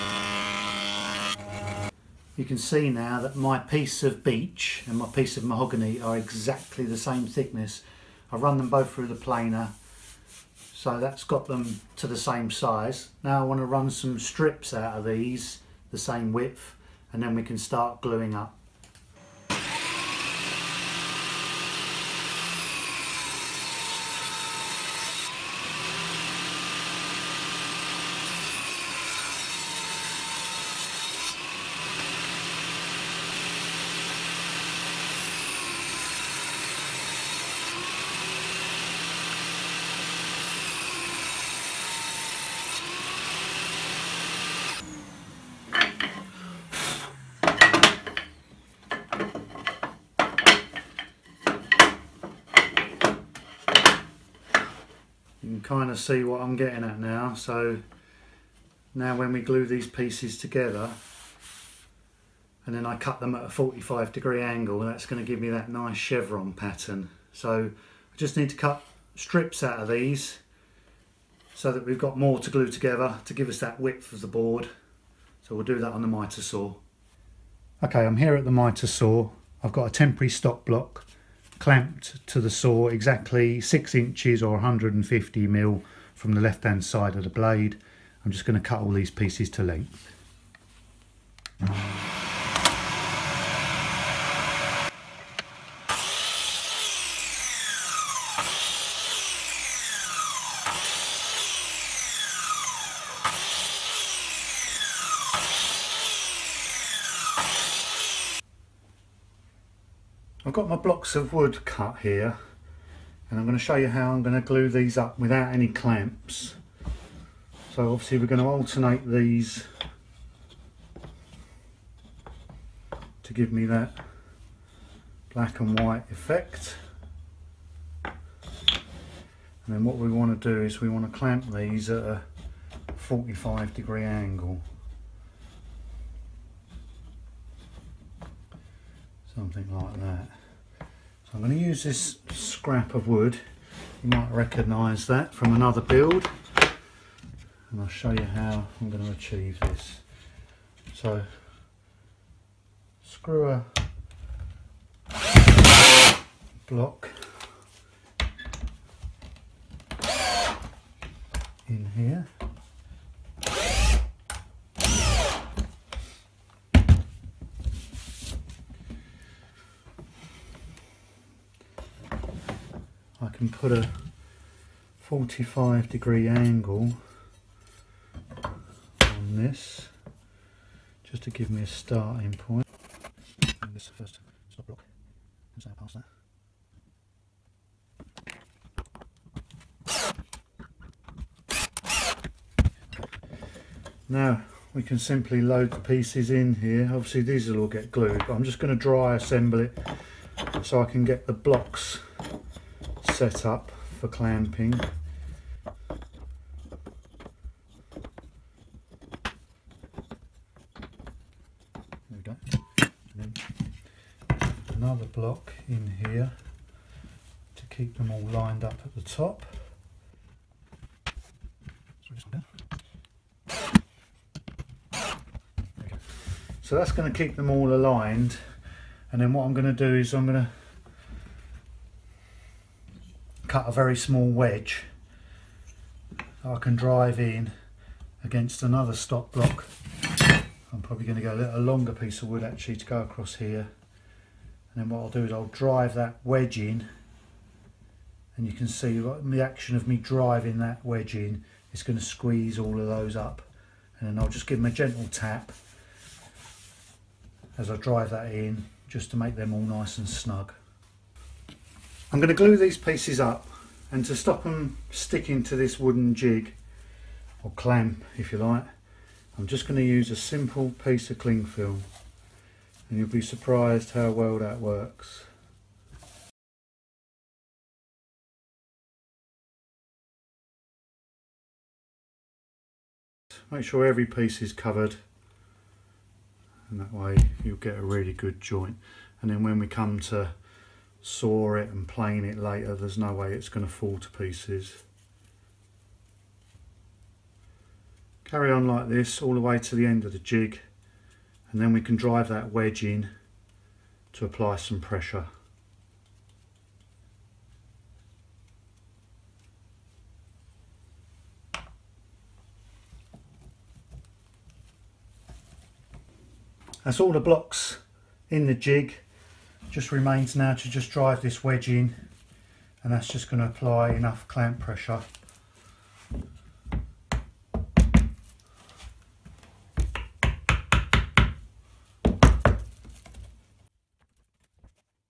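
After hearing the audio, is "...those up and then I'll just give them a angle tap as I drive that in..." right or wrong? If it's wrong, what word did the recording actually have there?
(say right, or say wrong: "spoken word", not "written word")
wrong: "gentle", not "angle".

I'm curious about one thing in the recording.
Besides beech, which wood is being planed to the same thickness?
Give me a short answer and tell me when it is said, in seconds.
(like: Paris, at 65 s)
Mahogany, at 5 s.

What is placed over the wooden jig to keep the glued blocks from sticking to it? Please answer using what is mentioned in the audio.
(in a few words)
Cling film.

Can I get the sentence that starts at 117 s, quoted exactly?
So obviously we're going to alternate these to give me that black and white effect.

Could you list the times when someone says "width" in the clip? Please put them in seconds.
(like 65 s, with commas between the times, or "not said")
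16 s, 73 s.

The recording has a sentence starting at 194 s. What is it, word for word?
Now we can simply load the pieces in here.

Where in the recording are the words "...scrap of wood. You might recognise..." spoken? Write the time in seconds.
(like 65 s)
142 s.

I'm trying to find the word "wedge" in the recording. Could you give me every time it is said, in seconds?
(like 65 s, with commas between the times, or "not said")
234 s, 246 s, 250 s, 302 s, 321 s.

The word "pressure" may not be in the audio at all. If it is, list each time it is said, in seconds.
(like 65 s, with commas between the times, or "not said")
304 s, 324 s.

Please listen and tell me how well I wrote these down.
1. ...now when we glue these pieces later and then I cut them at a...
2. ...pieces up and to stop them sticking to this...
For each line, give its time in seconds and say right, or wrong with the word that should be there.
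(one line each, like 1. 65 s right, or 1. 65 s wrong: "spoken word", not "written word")
1. 58 s wrong: "together", not "later"
2. 262 s right.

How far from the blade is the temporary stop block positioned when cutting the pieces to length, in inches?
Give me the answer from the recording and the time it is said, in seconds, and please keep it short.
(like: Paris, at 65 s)
6 inches, at 83 s.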